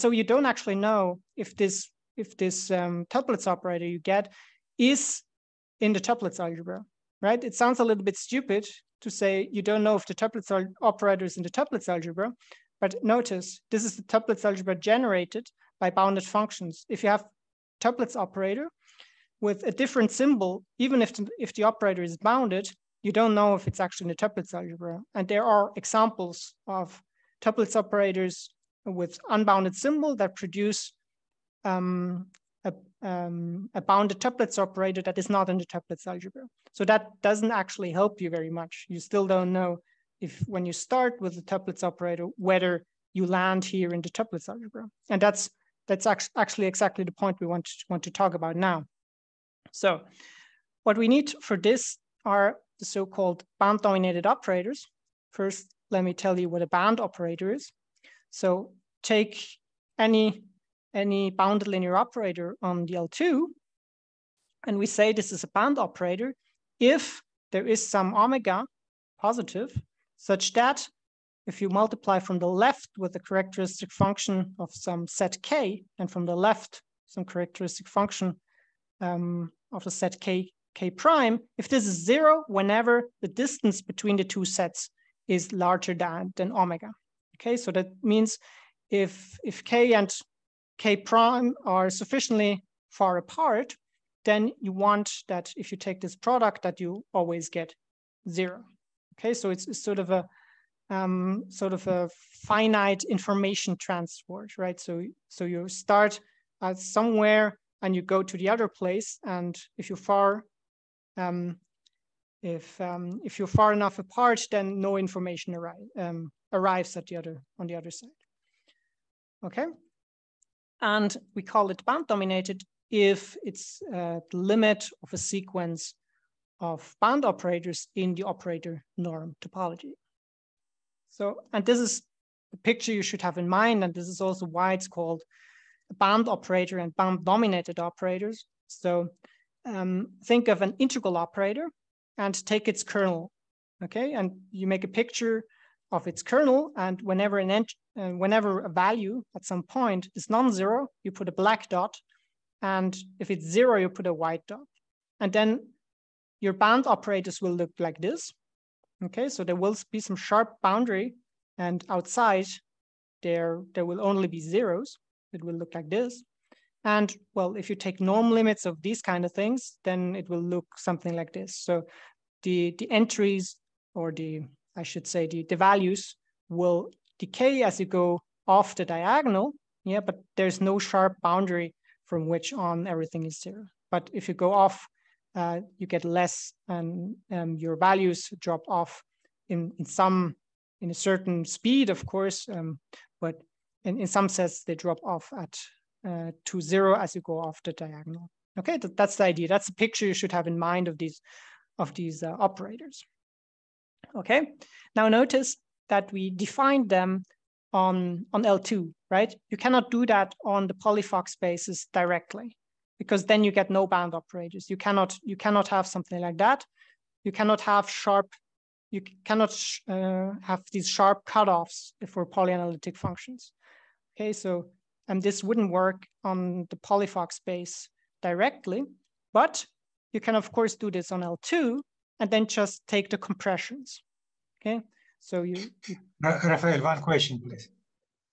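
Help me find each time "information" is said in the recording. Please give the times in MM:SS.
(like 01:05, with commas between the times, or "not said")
01:43, 01:54.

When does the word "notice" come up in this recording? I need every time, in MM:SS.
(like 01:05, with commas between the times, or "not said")
00:13, 03:25.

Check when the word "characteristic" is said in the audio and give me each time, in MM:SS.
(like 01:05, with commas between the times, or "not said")
01:13, 01:17.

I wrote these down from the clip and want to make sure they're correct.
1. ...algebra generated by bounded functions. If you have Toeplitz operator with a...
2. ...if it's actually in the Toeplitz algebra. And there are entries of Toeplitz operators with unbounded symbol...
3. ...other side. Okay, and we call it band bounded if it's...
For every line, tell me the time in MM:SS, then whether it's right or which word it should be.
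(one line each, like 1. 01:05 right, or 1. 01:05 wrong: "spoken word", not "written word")
1. 00:14 right
2. 00:23 wrong: "examples", not "entries"
3. 01:57 wrong: "dominated", not "bounded".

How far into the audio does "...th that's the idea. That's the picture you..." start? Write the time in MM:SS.
03:18.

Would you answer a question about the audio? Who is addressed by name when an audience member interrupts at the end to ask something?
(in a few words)
Rafael.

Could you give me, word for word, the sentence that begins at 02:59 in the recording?
Yeah, but there's no sharp boundary from which on everything is zero.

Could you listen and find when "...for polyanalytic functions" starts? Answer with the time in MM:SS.
03:42.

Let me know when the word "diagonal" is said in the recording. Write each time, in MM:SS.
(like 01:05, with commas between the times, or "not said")
02:58, 03:17.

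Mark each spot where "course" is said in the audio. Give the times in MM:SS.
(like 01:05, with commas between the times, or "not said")
03:12, 03:50.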